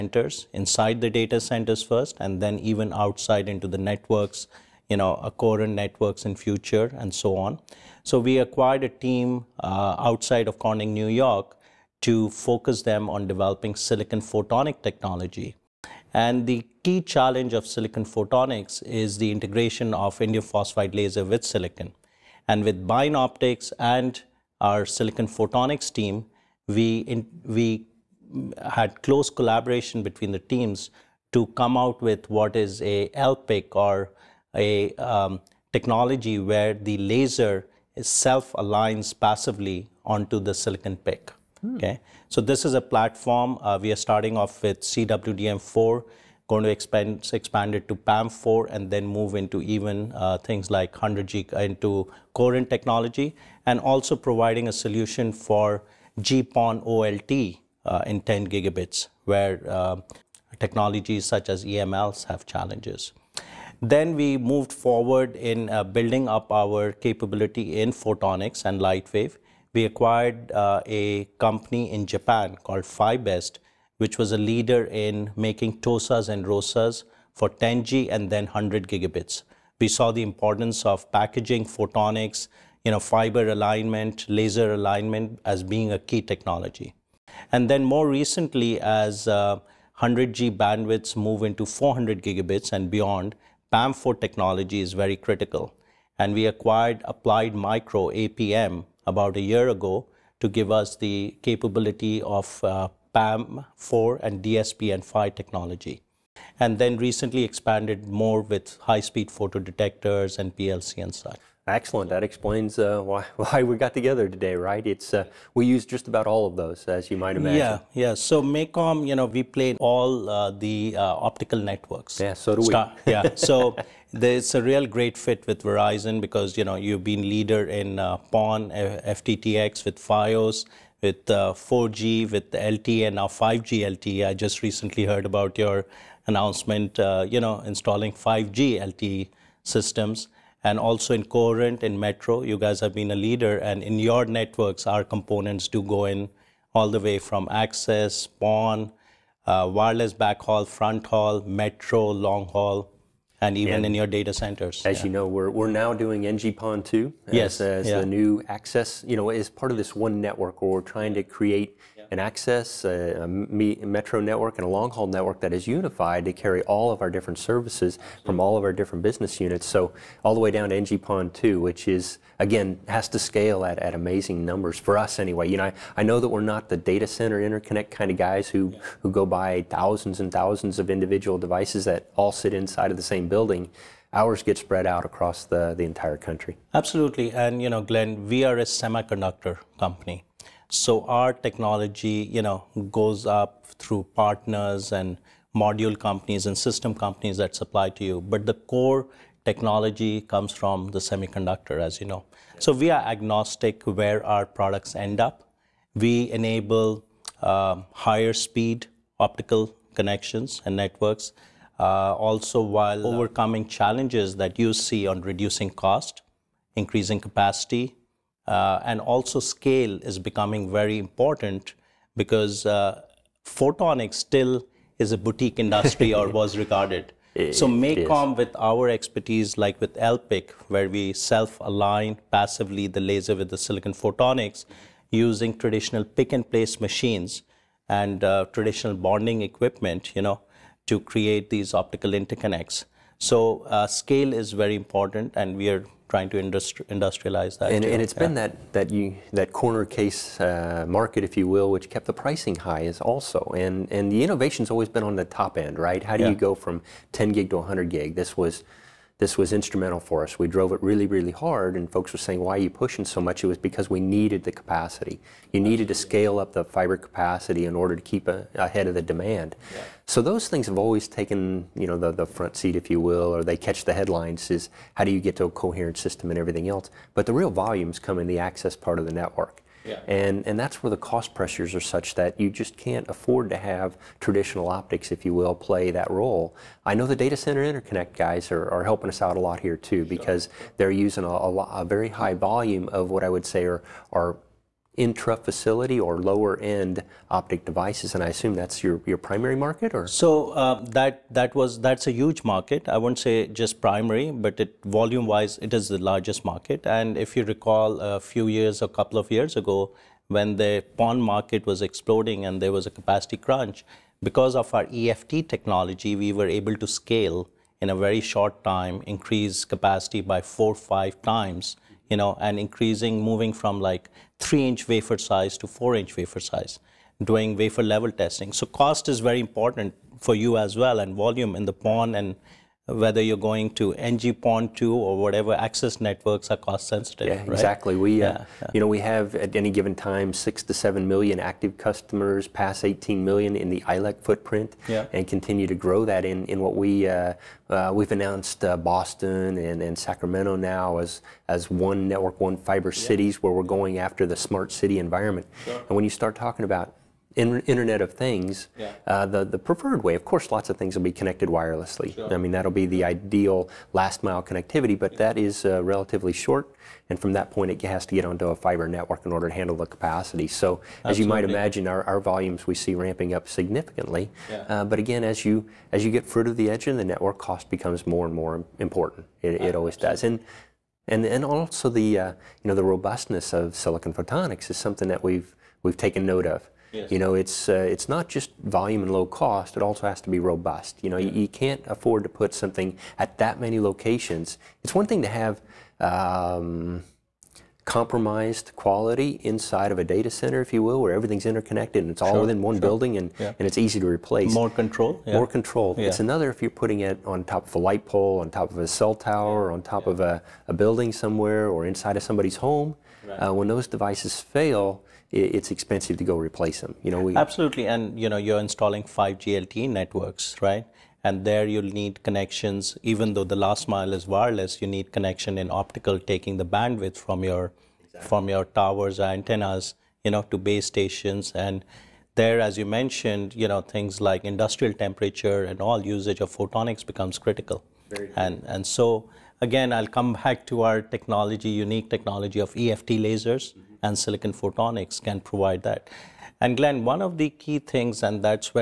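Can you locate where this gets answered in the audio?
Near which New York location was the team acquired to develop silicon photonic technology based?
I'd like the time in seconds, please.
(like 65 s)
10 s.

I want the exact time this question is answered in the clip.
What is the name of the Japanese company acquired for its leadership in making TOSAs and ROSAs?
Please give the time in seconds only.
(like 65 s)
72 s.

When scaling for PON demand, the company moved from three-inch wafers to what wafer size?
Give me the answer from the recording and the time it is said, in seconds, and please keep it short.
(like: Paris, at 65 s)
4-inch, at 325 s.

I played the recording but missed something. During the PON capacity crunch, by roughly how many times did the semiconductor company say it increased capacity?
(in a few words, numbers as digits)
4 to 5 times.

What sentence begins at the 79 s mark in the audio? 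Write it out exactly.
We saw the importance of packaging, photonics, you know, fiber alignment, laser alignment as being a key technology.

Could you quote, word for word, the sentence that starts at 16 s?
And the key challenge of silicon photonics is the integration of indium phosphide laser with silicon.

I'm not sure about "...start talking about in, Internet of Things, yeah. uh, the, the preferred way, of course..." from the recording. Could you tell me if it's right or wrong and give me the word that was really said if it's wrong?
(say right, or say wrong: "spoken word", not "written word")
right.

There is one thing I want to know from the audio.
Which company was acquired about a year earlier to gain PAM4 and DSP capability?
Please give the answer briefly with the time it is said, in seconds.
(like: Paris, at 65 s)
Applied Micro, at 97 s.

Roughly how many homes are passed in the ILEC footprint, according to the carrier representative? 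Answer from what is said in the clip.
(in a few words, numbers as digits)
18 million.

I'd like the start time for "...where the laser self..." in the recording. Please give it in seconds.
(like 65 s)
36 s.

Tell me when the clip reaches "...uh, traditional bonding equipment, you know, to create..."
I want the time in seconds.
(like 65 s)
238 s.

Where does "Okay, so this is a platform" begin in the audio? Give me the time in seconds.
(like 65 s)
41 s.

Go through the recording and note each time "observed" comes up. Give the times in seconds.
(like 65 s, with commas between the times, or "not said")
not said.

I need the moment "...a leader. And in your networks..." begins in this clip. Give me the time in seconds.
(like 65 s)
143 s.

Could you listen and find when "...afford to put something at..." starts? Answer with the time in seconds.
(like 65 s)
391 s.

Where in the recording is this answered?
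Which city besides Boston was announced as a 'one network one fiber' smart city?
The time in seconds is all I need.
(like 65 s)
349 s.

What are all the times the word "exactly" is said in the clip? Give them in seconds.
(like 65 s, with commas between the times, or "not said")
337 s, 428 s.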